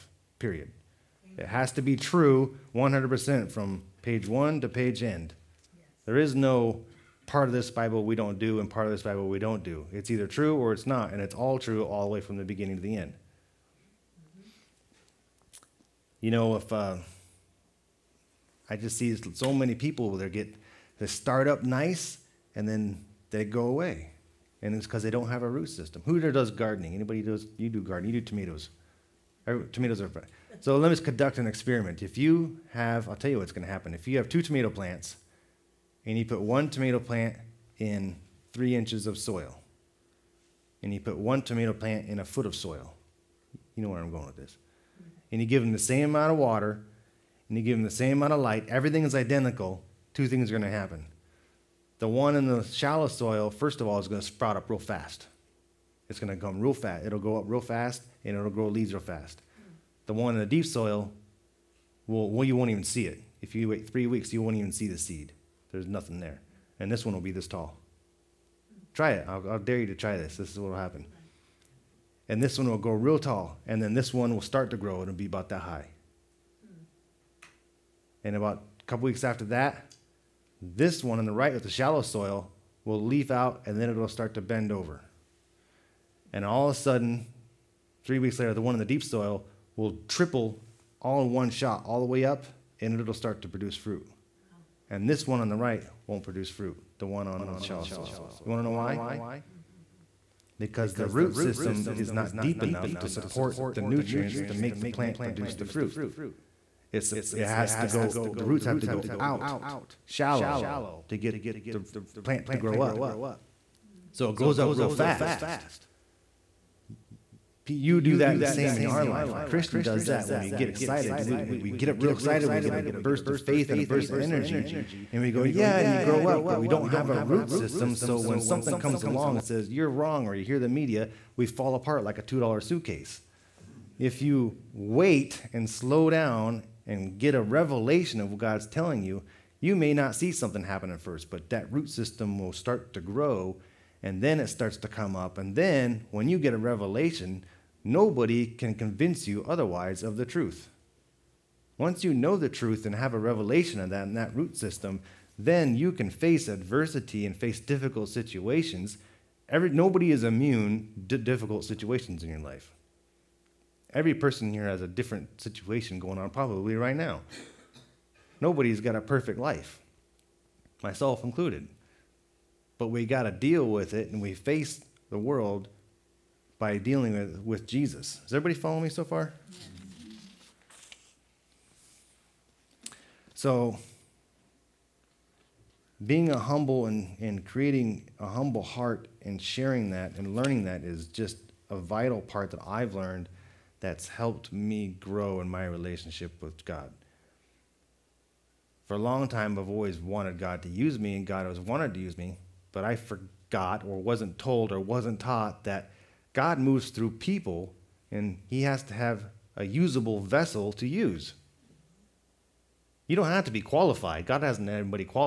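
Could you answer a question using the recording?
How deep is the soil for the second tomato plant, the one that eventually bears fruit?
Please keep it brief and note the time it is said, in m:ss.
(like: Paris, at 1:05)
a foot, at 0:42.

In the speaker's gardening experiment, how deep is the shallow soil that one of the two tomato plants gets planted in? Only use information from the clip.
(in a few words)
3 inches.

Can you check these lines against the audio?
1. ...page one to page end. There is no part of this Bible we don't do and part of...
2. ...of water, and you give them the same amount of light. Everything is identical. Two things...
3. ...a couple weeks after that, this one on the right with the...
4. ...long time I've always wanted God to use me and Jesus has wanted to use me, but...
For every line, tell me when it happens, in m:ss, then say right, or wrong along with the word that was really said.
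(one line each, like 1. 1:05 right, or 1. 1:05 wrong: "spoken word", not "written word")
1. 0:04 right
2. 0:46 right
3. 1:18 right
4. 3:18 wrong: "God", not "Jesus".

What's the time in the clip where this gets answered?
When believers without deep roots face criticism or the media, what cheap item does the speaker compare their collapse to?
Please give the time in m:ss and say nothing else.
2:12.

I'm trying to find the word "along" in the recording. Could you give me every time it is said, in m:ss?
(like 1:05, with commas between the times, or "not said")
2:09.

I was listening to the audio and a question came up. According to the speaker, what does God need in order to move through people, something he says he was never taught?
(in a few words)
a usable vessel.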